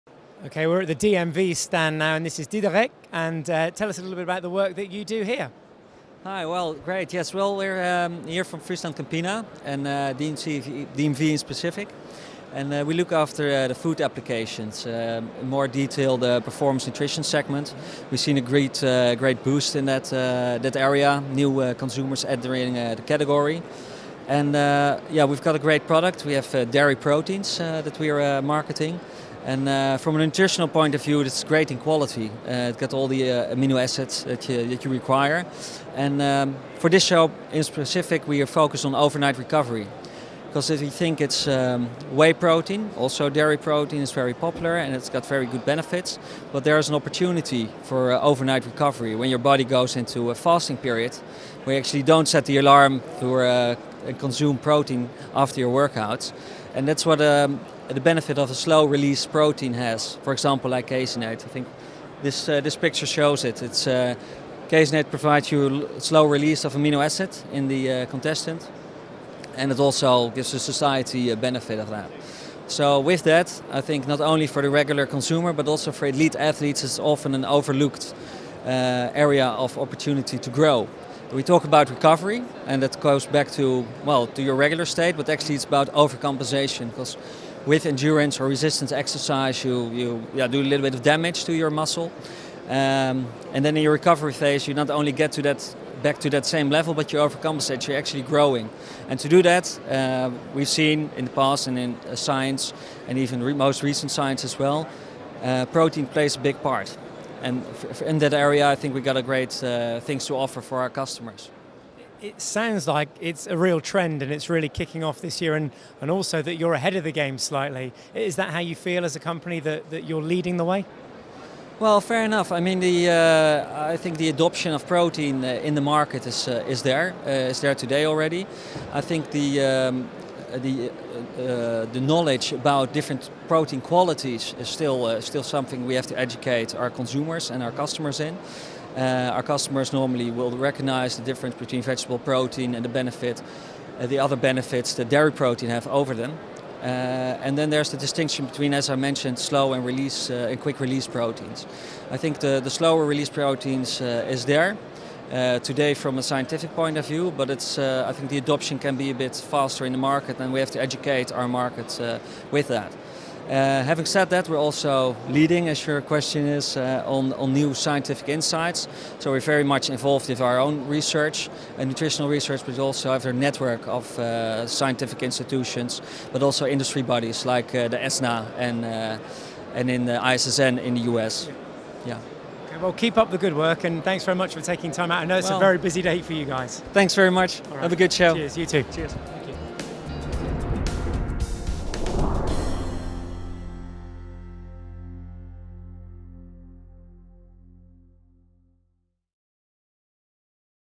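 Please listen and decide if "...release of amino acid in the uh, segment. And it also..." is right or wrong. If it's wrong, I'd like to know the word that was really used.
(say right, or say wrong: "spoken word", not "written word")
wrong: "contestant", not "segment".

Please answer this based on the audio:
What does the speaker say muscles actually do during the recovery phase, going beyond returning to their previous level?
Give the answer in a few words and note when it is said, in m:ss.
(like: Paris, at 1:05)
Overcompensation, at 1:25.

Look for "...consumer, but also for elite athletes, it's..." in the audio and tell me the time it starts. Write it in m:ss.
1:15.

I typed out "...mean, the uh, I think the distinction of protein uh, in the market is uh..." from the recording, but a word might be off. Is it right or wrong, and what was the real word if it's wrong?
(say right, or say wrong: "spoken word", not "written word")
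wrong: "adoption", not "distinction".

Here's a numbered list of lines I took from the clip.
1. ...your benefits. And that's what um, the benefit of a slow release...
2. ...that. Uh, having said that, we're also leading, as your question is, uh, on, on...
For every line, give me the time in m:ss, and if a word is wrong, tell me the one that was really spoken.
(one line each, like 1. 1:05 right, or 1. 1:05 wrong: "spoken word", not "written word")
1. 0:55 wrong: "workouts", not "benefits"
2. 2:42 right.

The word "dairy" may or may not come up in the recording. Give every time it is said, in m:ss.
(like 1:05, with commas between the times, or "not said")
0:26, 0:43, 2:25.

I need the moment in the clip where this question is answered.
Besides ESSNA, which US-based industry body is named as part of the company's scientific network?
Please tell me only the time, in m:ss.
3:00.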